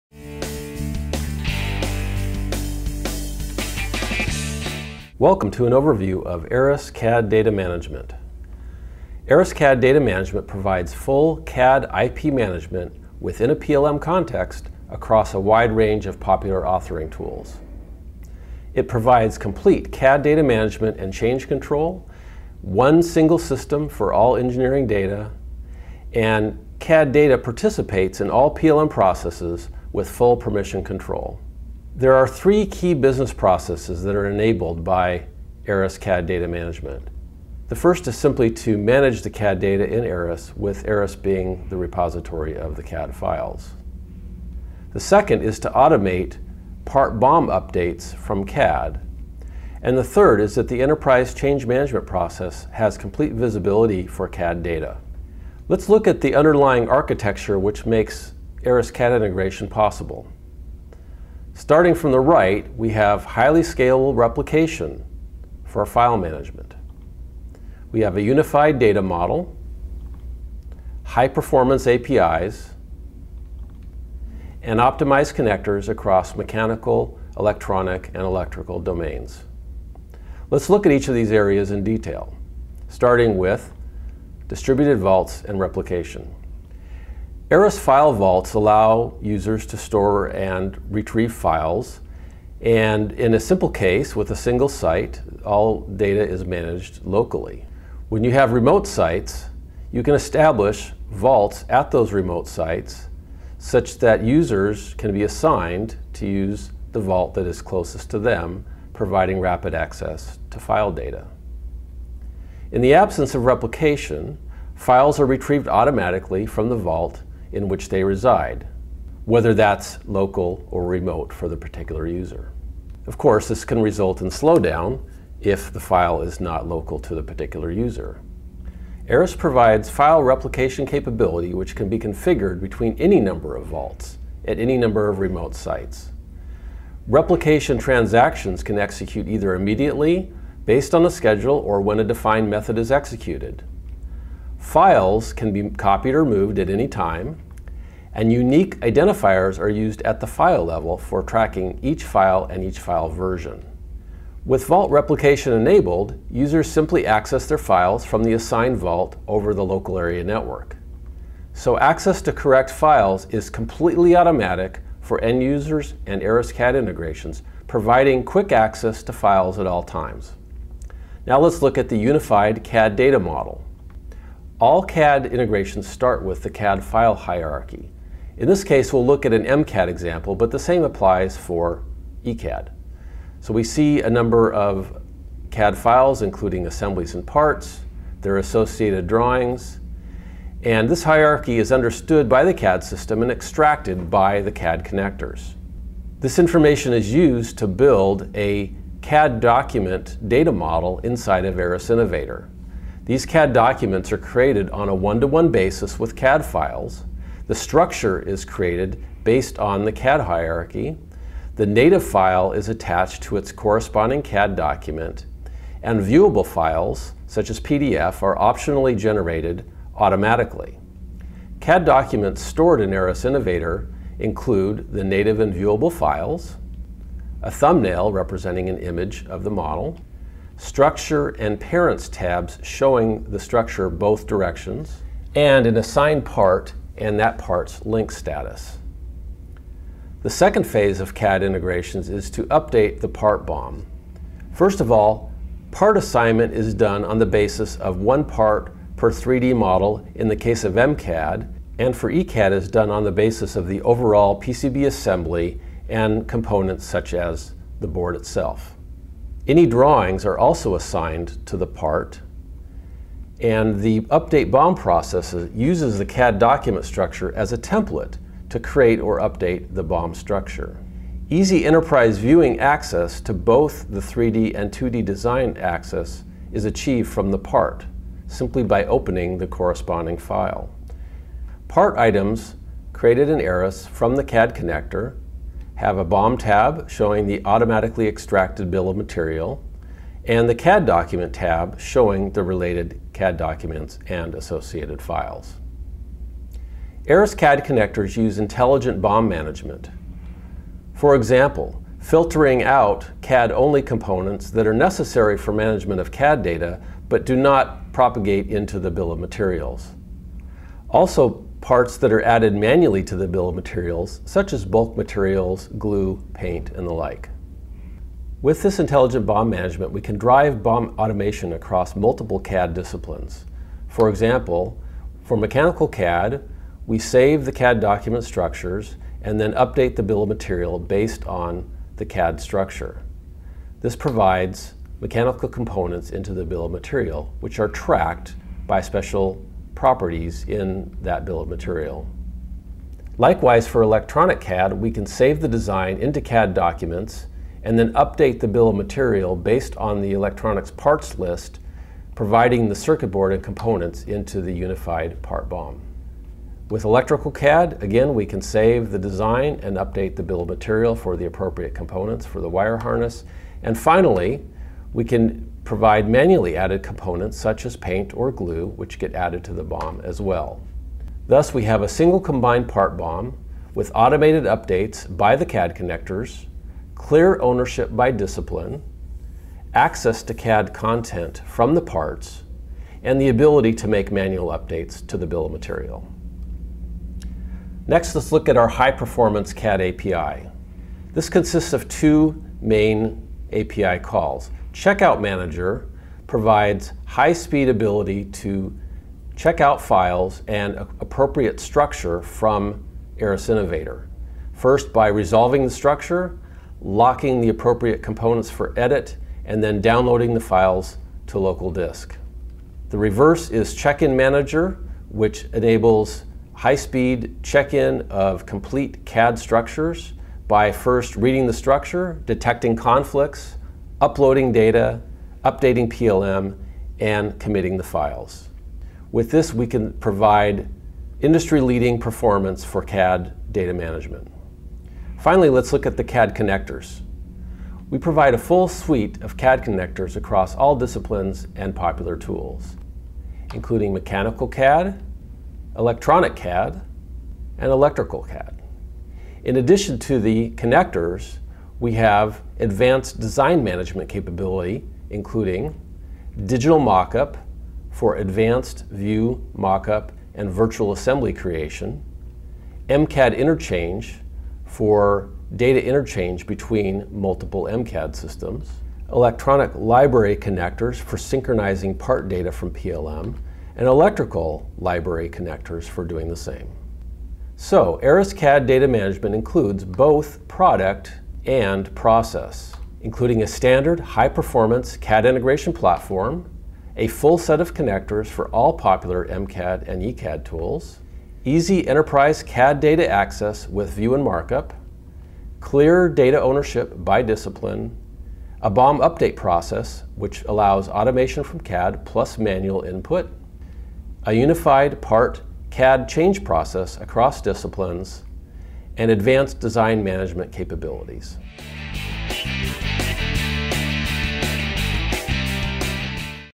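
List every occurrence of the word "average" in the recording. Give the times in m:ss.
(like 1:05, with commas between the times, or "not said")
not said.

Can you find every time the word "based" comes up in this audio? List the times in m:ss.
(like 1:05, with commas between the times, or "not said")
2:20, 3:29, 5:30, 5:49.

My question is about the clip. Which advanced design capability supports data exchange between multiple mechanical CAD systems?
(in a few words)
MCAD interchange.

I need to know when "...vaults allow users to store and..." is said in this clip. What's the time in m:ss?
1:28.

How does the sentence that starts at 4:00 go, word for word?
The second phase of CAD integrations is to update the part BOM.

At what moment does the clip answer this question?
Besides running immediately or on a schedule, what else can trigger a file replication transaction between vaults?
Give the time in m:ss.
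2:21.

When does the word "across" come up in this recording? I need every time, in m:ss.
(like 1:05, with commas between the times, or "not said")
0:14, 1:15, 5:21, 7:20, 8:26.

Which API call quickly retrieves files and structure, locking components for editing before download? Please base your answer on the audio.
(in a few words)
Checkout Manager.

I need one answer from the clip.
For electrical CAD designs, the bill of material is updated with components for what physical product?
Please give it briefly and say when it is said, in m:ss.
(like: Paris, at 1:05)
wire harness, at 6:02.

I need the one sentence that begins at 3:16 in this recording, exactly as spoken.
This information is used to build a CAD document data model inside of Aras Innovator.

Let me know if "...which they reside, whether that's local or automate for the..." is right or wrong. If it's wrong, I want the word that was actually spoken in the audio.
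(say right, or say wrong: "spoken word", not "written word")
wrong: "remote", not "automate".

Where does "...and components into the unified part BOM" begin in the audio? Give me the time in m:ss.
5:53.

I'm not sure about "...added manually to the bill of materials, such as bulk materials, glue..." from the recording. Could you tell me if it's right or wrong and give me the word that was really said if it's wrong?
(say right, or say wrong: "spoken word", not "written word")
right.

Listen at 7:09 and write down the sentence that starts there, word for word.
With this, we can provide industry-leading performance for CAD data management.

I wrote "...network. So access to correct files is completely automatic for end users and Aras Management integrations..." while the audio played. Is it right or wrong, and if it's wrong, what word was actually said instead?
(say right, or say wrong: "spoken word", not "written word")
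wrong: "CAD", not "Management".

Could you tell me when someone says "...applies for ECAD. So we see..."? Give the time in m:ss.
3:00.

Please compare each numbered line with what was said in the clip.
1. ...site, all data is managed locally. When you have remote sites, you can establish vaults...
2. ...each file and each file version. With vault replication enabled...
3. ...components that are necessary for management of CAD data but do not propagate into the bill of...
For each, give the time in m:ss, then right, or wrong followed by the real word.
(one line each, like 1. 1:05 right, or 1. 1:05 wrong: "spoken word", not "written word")
1. 1:34 right
2. 2:31 right
3. 5:03 right.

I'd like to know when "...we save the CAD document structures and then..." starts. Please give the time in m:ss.
5:26.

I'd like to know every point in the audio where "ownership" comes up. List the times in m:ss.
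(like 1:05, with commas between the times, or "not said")
6:17, 8:16.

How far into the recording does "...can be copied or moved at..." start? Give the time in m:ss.
2:25.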